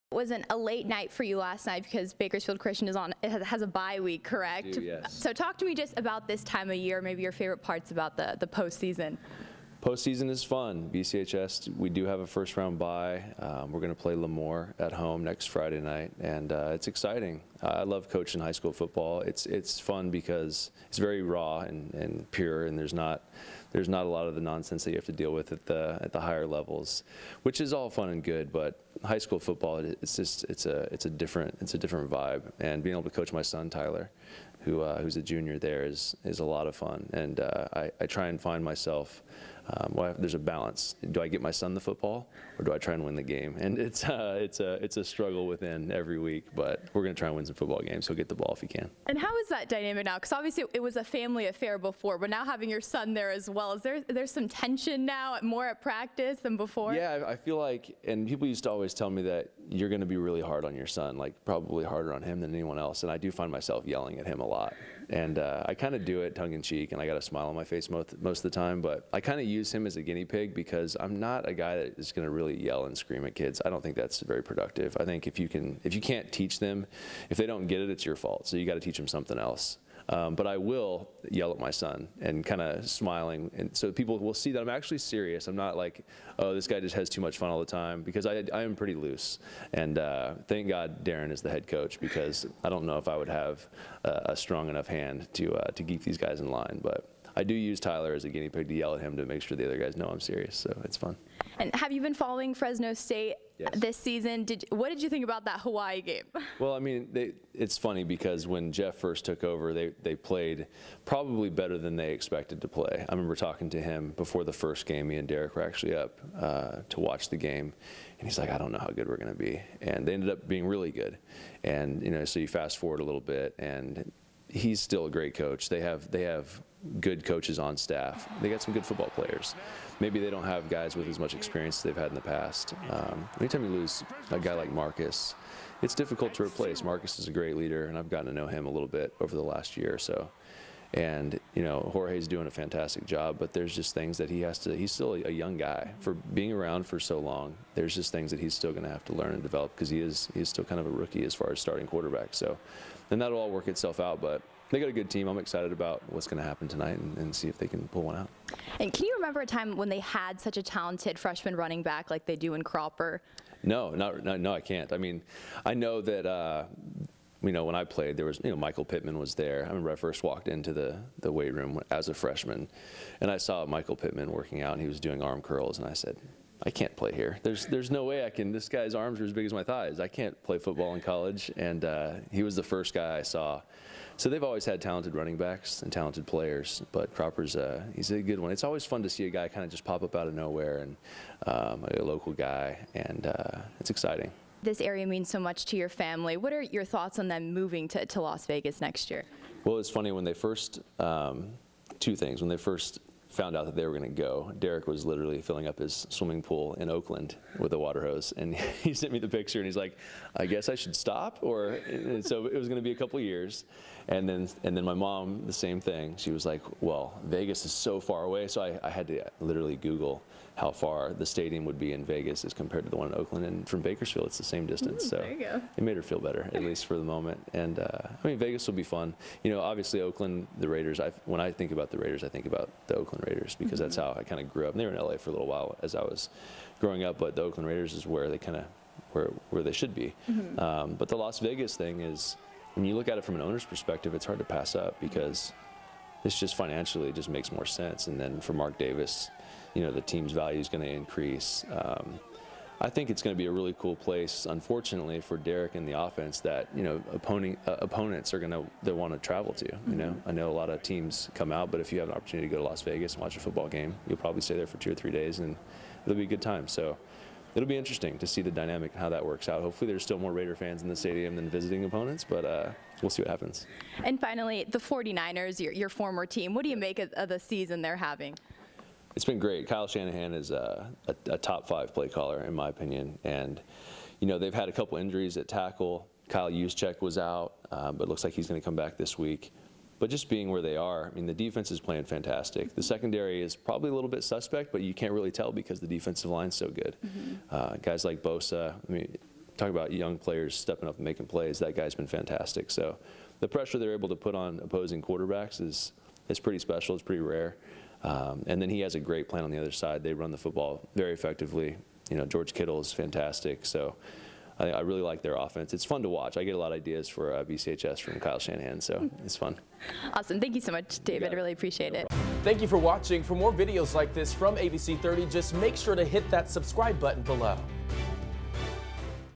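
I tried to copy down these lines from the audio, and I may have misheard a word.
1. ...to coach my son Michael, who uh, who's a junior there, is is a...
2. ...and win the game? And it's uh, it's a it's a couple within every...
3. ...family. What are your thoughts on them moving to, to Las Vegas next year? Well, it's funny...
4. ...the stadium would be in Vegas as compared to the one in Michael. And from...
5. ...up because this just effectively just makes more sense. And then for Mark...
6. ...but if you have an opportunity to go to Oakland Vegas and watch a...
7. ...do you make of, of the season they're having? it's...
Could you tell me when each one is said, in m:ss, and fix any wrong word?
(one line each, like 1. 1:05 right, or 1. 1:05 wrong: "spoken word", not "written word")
1. 0:33 wrong: "Tyler", not "Michael"
2. 0:42 wrong: "struggle", not "couple"
3. 3:15 right
4. 3:41 wrong: "Oakland", not "Michael"
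5. 4:04 wrong: "financially", not "effectively"
6. 4:21 wrong: "Las", not "Oakland"
7. 4:36 right.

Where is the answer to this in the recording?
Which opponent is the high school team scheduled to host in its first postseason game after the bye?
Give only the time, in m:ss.
0:14.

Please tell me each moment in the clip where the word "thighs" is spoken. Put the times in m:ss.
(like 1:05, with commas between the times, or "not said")
2:59.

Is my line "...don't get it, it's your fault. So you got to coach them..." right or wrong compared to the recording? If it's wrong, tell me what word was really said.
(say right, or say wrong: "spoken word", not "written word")
wrong: "teach", not "coach".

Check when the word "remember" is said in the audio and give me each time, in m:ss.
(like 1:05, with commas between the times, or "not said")
1:53, 2:39, 2:49.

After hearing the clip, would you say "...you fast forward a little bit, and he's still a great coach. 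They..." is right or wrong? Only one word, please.
right.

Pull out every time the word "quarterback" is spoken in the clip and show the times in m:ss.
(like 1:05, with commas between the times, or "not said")
2:31, 5:05.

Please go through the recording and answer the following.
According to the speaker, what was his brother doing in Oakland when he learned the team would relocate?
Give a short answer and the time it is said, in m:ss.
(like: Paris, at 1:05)
filling up his swimming pool, at 3:25.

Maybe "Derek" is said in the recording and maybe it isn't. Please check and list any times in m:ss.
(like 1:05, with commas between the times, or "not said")
1:55, 3:24, 4:15.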